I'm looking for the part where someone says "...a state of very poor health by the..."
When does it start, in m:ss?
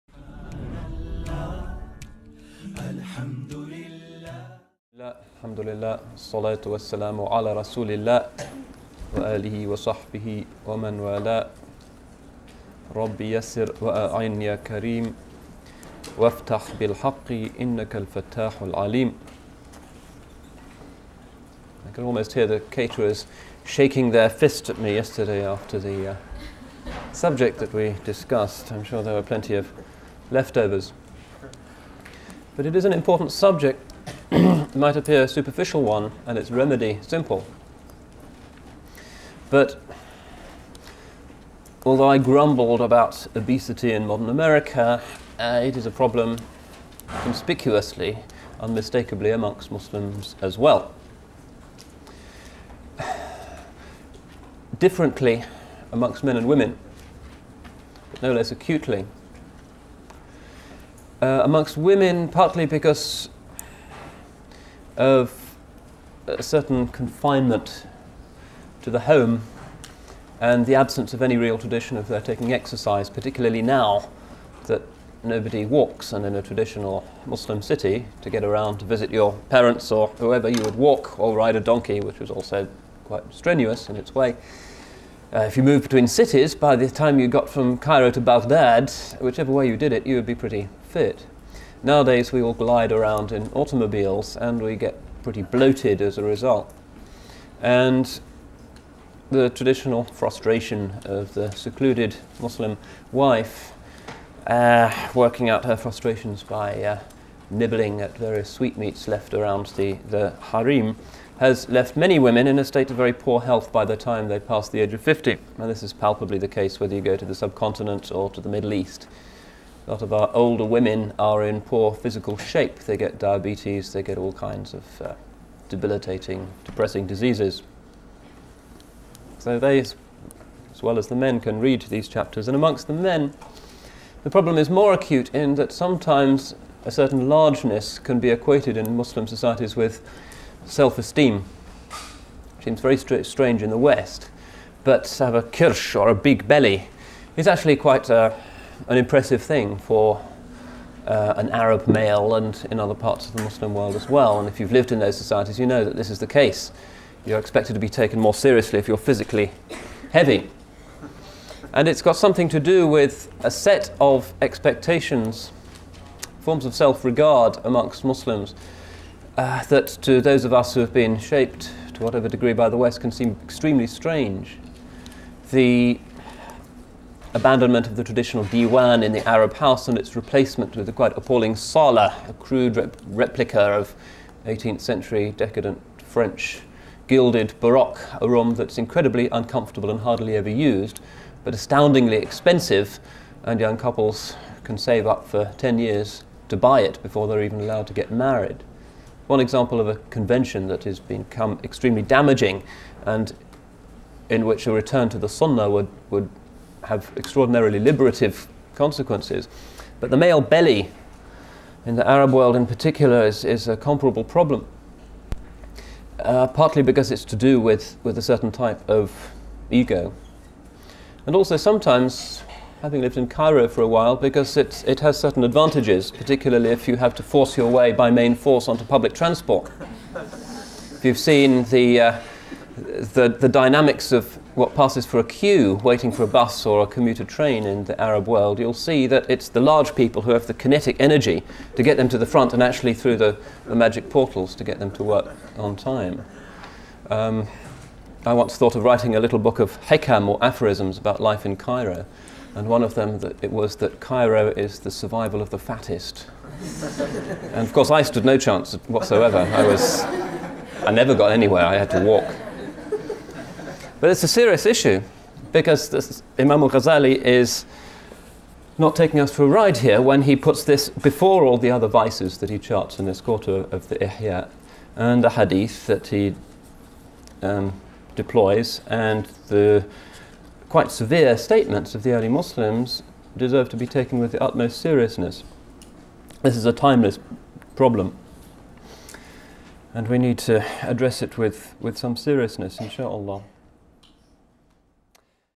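1:52.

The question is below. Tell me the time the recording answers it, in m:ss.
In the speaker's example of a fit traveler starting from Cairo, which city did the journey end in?
1:28.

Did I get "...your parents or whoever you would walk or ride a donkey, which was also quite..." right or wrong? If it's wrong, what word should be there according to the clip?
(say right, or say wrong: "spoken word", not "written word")
right.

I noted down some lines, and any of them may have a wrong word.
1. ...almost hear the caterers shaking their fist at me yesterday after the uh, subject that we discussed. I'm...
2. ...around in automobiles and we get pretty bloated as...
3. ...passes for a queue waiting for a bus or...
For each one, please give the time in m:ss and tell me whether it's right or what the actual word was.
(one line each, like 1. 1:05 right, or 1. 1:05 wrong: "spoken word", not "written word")
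1. 0:22 right
2. 1:32 right
3. 3:54 right.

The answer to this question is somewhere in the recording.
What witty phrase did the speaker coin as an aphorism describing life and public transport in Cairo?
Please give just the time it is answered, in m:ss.
4:14.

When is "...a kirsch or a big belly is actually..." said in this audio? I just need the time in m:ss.
2:25.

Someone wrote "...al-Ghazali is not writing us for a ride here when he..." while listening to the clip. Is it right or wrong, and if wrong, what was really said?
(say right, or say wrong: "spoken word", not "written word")
wrong: "taking", not "writing".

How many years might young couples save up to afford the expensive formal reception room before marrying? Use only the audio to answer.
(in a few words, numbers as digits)
10.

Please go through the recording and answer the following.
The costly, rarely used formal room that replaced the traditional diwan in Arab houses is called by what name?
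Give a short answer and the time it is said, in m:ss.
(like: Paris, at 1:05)
sala, at 3:01.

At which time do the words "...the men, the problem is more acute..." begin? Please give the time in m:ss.
2:12.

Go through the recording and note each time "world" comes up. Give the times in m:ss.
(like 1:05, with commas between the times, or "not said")
2:33, 3:32, 3:58.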